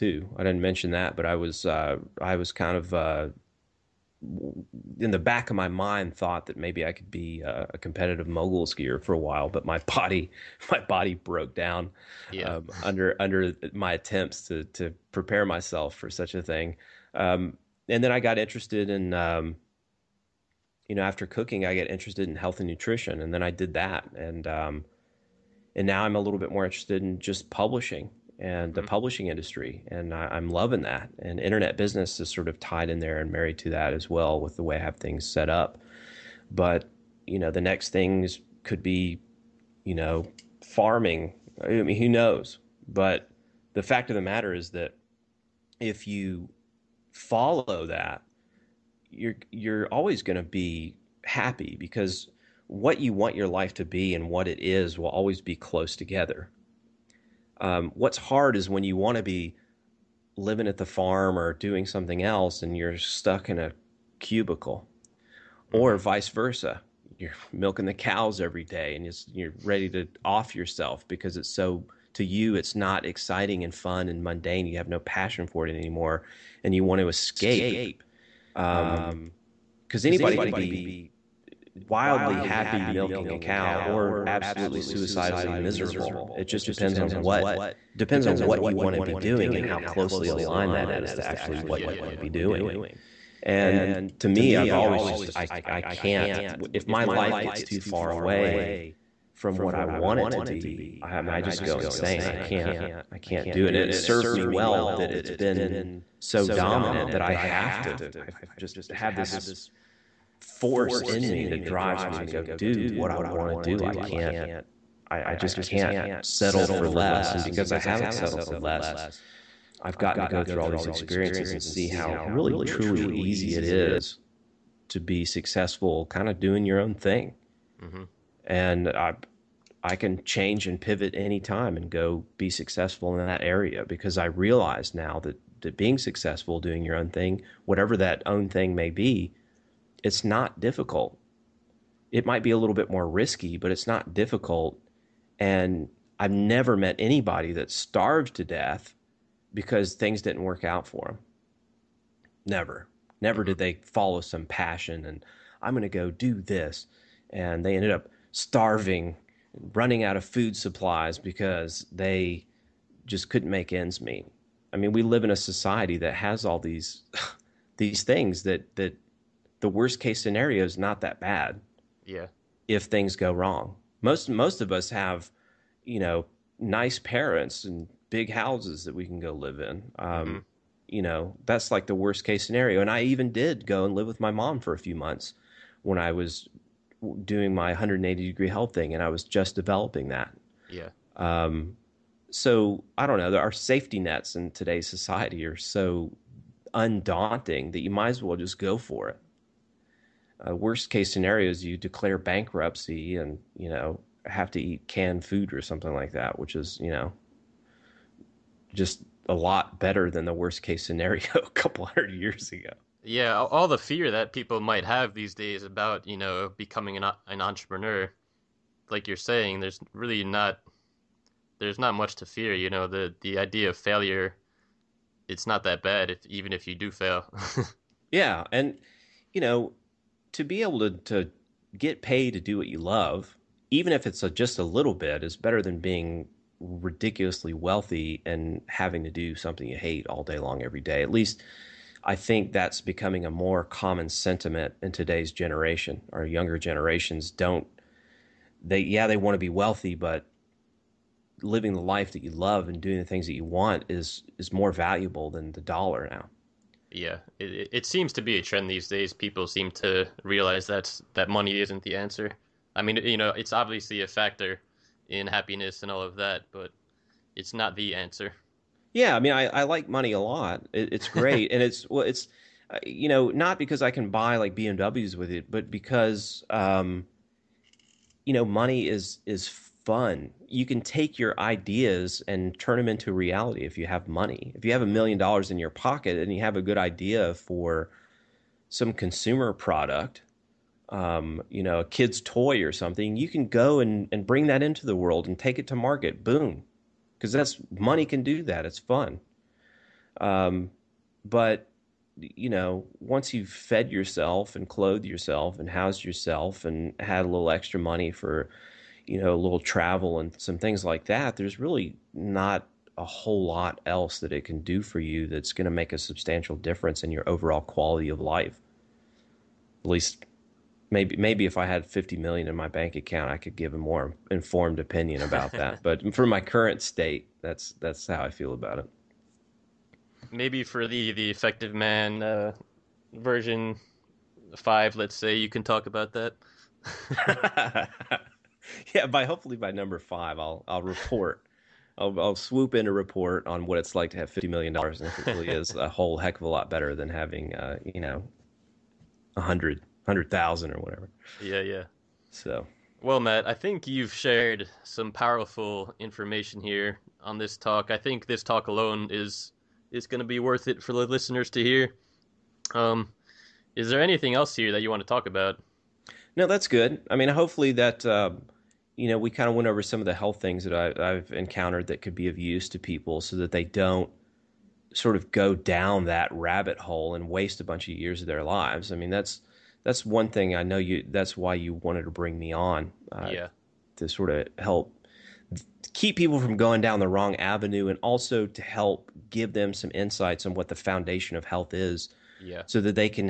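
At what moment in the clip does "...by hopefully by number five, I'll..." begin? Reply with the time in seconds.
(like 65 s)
339 s.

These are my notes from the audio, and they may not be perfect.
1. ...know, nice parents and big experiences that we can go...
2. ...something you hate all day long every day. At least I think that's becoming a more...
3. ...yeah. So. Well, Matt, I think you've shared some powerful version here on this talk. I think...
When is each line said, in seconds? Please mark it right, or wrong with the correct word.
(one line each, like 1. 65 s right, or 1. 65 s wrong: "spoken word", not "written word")
1. 175 s wrong: "houses", not "experiences"
2. 239 s right
3. 351 s wrong: "information", not "version".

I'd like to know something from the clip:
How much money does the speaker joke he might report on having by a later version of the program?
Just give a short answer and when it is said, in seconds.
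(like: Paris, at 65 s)
$50 million, at 344 s.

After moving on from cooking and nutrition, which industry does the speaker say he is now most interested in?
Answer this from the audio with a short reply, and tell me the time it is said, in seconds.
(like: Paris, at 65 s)
publishing industry, at 28 s.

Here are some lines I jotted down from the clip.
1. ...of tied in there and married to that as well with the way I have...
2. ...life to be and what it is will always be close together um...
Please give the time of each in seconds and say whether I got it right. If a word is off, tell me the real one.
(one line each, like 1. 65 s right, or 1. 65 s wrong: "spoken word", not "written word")
1. 32 s right
2. 53 s right.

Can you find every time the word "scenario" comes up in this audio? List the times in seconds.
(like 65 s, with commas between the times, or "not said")
170 s, 182 s, 201 s, 210 s.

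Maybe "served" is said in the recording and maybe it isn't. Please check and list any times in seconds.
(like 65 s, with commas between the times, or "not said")
103 s.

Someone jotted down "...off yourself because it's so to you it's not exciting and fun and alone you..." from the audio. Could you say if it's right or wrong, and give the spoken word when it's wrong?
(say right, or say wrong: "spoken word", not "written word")
wrong: "mundane", not "alone".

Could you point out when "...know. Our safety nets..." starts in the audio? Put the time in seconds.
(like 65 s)
193 s.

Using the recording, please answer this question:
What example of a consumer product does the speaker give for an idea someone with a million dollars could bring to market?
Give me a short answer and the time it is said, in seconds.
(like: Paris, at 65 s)
a kid's toy, at 291 s.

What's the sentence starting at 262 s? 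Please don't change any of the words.
I mean, you know, it's obviously a factor in happiness and all of that, but it's not the answer.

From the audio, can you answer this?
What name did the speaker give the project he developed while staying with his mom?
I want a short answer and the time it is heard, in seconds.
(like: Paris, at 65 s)
180 degree health, at 187 s.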